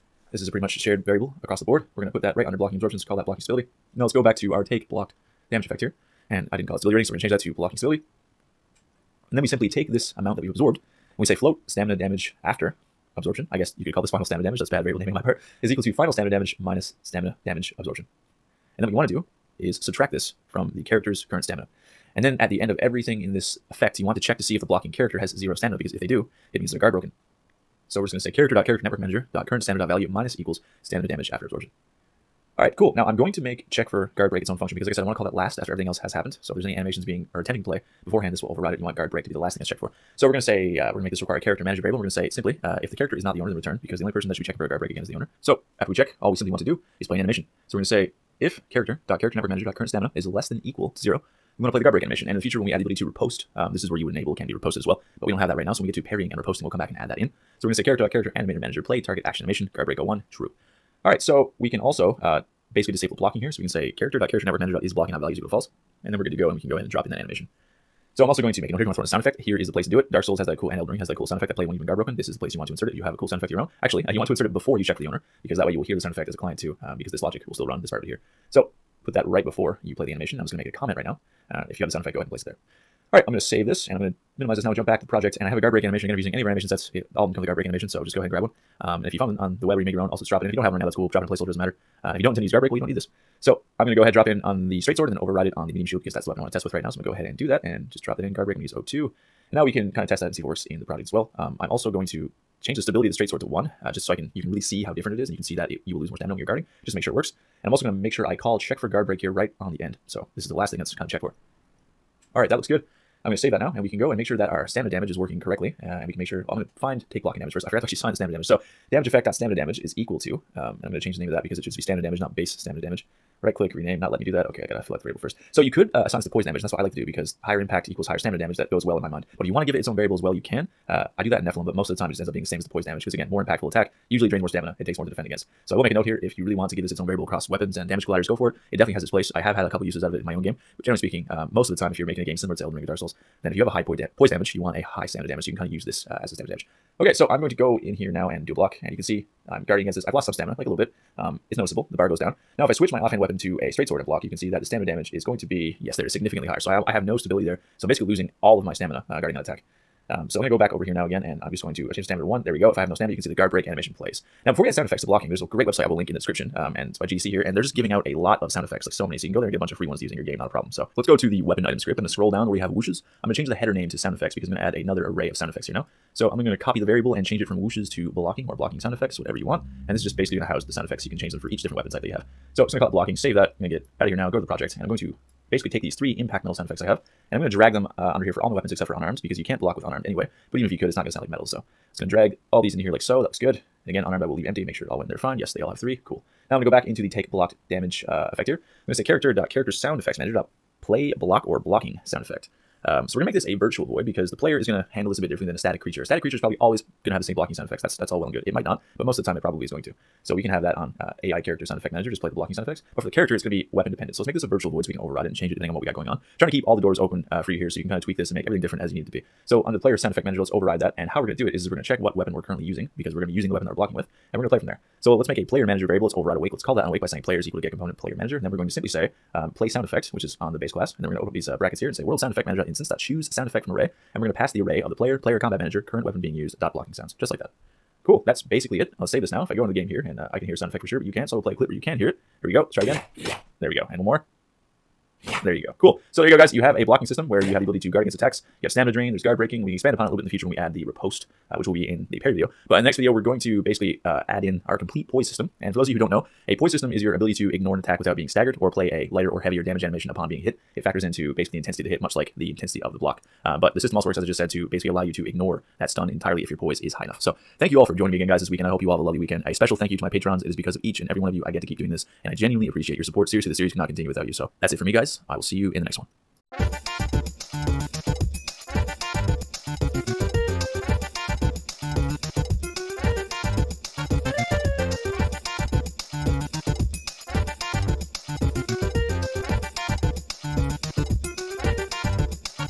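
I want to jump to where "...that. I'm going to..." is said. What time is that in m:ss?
3:03.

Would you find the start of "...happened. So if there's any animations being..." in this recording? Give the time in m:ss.
0:36.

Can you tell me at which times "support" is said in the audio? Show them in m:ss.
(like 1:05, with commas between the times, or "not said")
4:33.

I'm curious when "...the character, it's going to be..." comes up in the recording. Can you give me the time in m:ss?
3:33.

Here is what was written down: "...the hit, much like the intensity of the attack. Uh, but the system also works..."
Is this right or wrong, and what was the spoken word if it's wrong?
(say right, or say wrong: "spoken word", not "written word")
wrong: "block", not "attack".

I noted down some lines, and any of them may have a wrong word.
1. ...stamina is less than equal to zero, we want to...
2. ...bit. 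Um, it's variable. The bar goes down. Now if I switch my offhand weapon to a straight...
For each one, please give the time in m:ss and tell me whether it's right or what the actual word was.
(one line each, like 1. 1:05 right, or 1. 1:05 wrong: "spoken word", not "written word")
1. 0:49 right
2. 2:30 wrong: "noticeable", not "variable".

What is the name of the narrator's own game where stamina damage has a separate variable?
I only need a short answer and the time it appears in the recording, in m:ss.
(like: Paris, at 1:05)
Nephilim, at 2:11.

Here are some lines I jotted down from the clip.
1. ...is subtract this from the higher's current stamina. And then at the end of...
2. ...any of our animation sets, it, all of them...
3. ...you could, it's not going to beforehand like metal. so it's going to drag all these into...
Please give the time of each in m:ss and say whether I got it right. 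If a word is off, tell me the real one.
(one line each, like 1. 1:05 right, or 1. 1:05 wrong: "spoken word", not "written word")
1. 0:19 wrong: "character", not "higher"
2. 1:26 right
3. 3:10 wrong: "sound", not "beforehand".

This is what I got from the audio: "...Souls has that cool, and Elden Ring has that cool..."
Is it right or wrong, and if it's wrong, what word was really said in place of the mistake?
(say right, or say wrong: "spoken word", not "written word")
right.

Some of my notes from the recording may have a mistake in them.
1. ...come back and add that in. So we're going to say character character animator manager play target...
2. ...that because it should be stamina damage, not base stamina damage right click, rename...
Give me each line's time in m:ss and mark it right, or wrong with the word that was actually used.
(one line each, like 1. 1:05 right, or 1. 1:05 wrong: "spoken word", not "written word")
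1. 0:56 right
2. 2:01 right.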